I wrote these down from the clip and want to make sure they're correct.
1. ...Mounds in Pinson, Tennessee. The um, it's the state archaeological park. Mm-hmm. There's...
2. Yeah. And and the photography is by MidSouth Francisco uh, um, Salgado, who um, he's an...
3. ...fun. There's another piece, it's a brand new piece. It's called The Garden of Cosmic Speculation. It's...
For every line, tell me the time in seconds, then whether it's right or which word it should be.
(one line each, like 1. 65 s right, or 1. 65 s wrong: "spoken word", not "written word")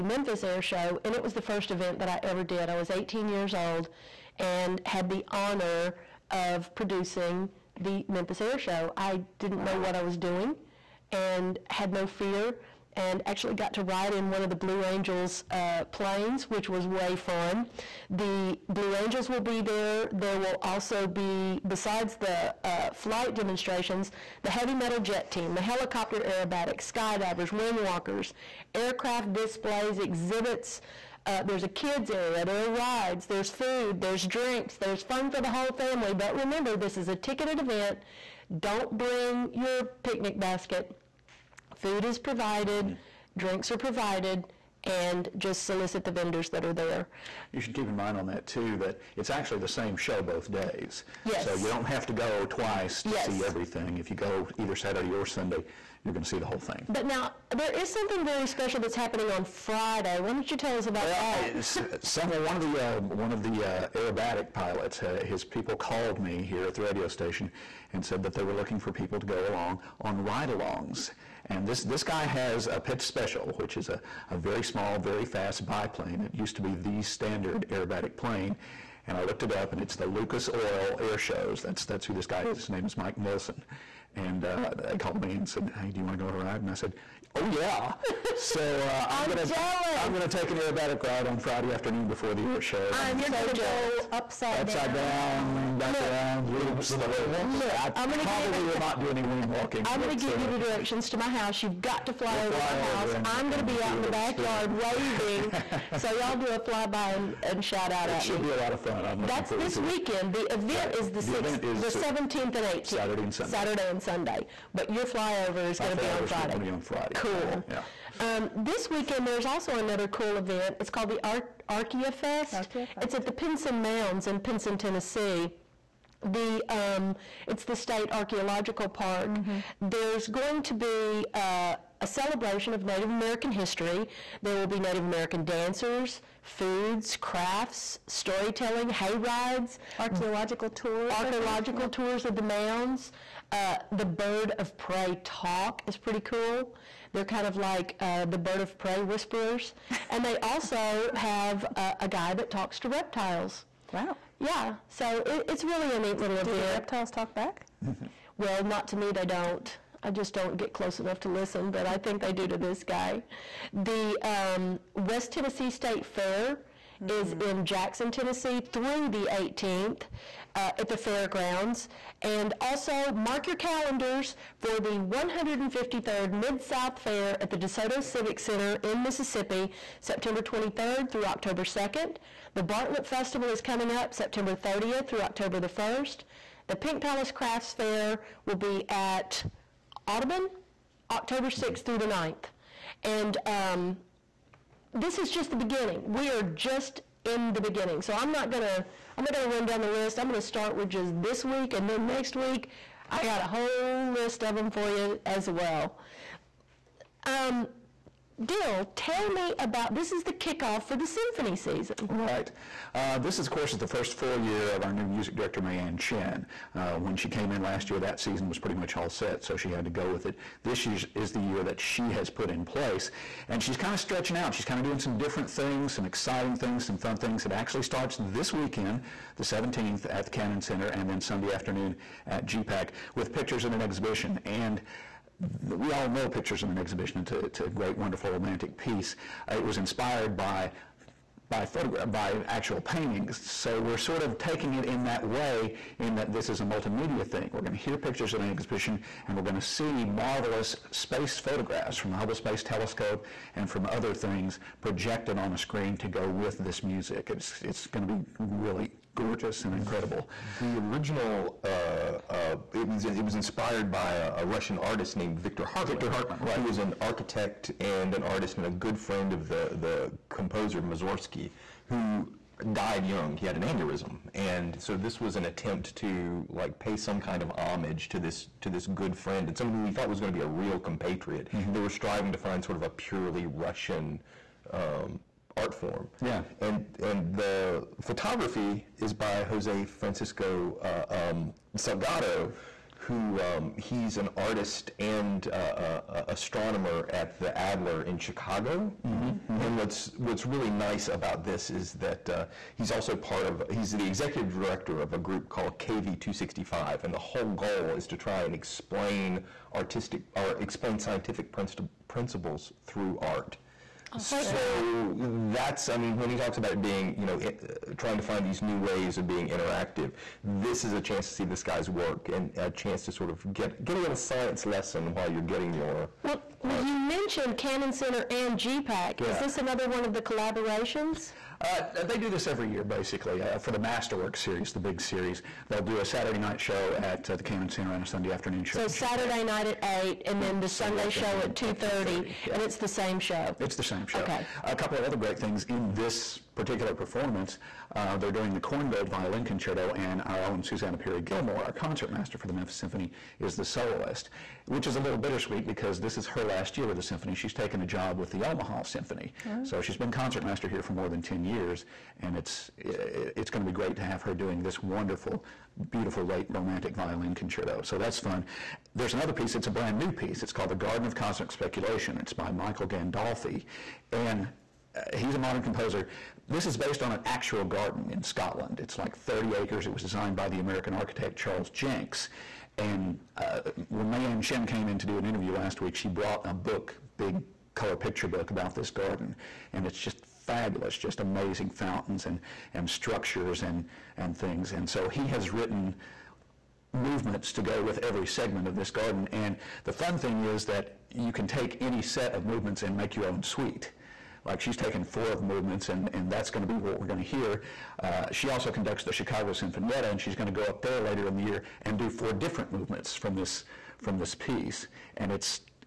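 1. 123 s right
2. 286 s wrong: "Jose", not "MidSouth"
3. 368 s right.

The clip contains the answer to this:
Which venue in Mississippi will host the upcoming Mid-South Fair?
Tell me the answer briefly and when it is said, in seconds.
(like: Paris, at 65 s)
DeSoto Civic Center, at 177 s.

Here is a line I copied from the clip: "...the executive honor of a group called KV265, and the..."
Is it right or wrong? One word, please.
wrong.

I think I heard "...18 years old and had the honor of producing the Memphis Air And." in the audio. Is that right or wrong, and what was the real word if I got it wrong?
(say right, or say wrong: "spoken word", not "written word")
wrong: "Show", not "And".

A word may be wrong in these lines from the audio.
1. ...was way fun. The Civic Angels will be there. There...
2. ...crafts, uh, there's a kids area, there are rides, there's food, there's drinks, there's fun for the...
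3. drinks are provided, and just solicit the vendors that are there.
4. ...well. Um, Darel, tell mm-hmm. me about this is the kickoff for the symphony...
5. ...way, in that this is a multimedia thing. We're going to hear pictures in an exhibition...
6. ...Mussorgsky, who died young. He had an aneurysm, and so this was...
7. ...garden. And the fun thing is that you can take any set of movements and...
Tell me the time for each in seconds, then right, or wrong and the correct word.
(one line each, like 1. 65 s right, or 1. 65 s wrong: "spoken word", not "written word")
1. 16 s wrong: "Blue", not "Civic"
2. 29 s wrong: "exhibits", not "crafts"
3. 43 s right
4. 205 s right
5. 245 s right
6. 270 s right
7. 398 s right.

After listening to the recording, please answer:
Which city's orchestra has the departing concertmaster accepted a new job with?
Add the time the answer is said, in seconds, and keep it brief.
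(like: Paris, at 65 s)
Omaha, at 358 s.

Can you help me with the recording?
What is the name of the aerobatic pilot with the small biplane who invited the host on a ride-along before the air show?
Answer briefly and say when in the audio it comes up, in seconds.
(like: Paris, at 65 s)
Mike Nilsson, at 82 s.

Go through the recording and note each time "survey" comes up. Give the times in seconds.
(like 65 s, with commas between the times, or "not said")
not said.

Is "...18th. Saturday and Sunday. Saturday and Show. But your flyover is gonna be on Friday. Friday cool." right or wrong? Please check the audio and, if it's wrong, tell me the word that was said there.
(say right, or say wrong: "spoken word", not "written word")
wrong: "Sunday", not "Show".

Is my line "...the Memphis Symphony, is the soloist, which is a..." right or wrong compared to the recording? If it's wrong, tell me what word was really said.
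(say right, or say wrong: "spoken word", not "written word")
right.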